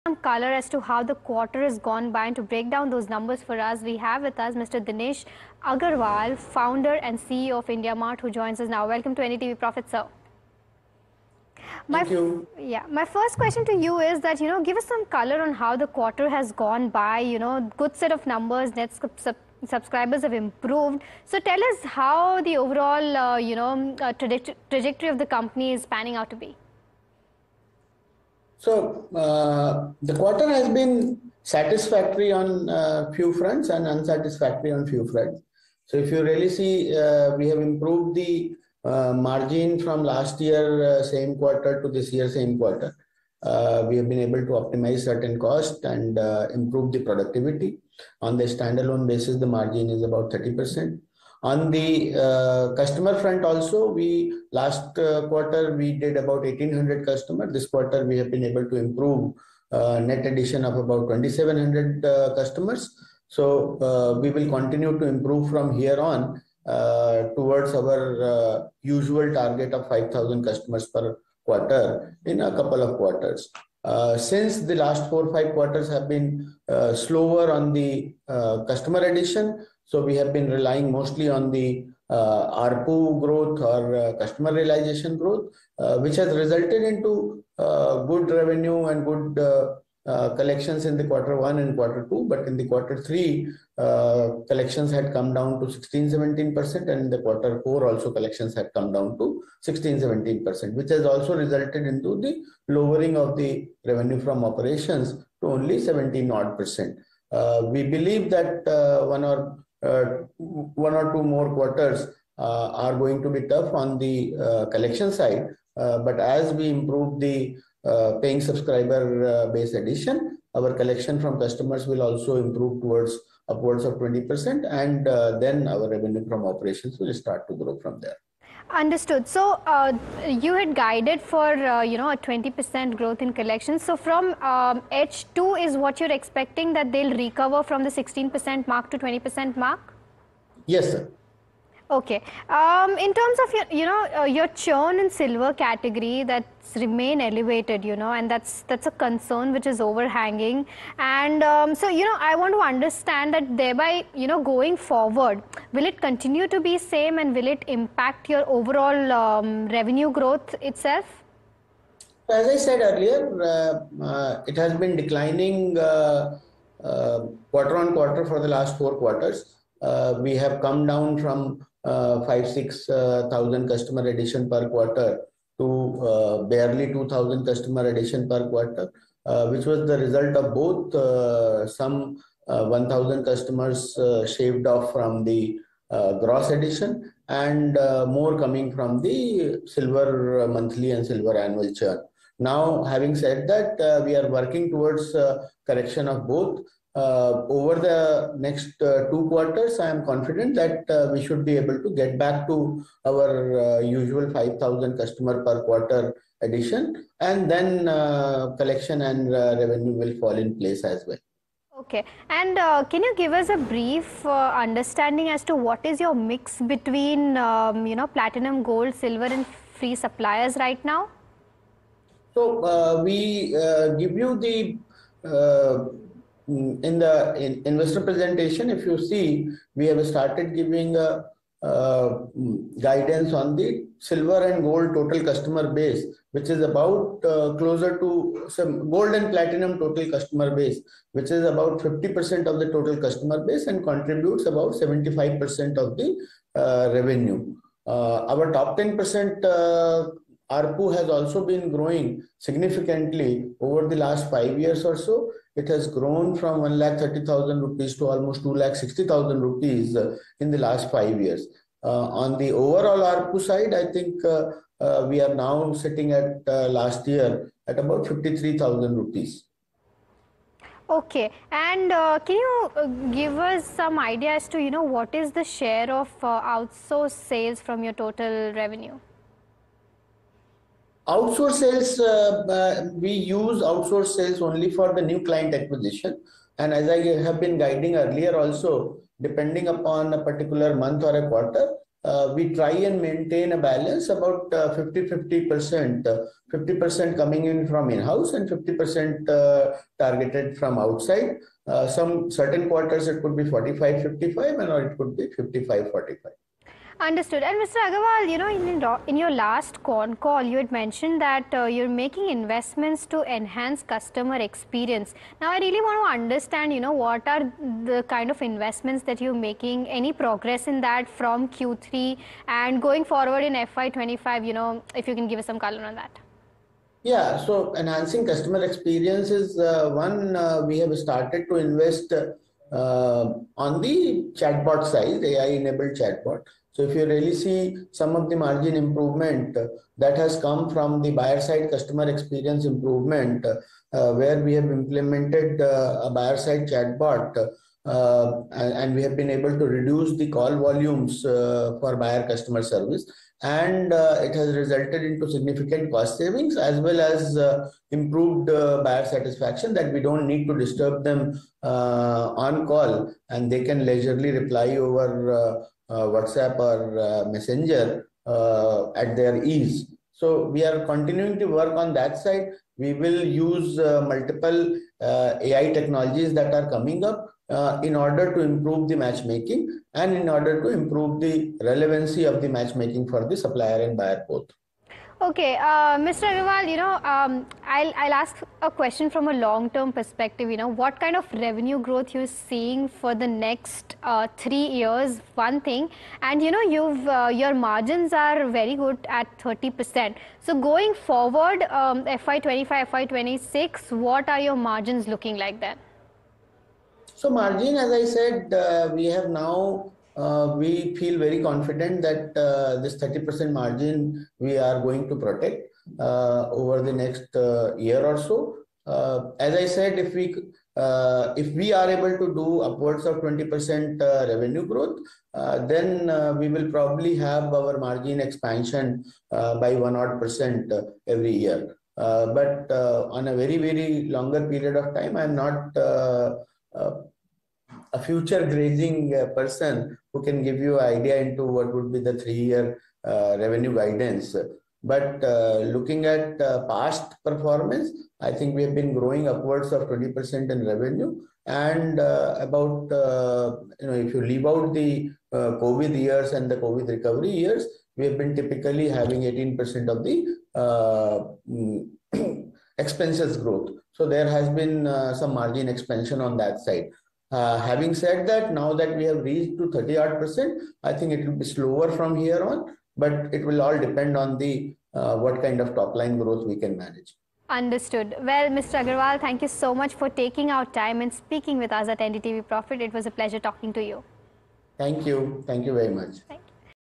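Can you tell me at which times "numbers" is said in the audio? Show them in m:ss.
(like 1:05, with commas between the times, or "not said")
0:03, 0:18.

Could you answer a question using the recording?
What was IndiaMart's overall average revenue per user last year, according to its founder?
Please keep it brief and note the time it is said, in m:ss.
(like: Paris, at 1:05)
53,000 rupees, at 4:28.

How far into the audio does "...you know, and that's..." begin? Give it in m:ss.
2:27.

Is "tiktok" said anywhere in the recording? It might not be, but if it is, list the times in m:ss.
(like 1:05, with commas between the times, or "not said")
not said.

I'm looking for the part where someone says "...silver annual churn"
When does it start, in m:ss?
3:11.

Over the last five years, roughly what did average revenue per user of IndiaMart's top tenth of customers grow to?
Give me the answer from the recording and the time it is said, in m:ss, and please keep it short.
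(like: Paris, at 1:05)
2,60,000 rupees, at 4:18.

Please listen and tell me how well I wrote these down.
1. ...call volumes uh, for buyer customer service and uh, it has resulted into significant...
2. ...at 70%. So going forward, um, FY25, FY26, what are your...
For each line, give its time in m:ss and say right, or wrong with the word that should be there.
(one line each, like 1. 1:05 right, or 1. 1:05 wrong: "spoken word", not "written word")
1. 5:50 right
2. 6:39 wrong: "30", not "70".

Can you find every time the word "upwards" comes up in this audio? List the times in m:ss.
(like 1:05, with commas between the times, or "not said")
2:03, 7:02, 7:29.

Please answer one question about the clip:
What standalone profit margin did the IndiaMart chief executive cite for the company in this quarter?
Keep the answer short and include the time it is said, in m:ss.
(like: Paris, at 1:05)
30 percent, at 0:49.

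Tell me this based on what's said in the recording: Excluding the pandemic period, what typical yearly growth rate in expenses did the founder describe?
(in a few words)
18%.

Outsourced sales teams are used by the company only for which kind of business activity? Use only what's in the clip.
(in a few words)
new client acquisition.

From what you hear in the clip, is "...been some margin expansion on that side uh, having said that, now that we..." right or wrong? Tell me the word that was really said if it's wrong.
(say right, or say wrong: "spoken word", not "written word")
right.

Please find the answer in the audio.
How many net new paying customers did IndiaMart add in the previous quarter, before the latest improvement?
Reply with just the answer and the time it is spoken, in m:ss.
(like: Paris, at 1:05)
1,800, at 0:56.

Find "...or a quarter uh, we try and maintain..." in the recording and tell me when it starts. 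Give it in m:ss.
4:51.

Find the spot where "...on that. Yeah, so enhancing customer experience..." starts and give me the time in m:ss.
5:25.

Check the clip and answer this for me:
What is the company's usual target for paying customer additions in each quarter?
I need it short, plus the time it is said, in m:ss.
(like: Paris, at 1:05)
5,000, at 1:09.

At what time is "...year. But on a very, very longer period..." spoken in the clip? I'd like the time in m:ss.
7:11.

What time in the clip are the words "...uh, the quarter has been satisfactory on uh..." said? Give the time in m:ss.
0:29.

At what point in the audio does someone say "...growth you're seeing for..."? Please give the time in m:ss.
6:31.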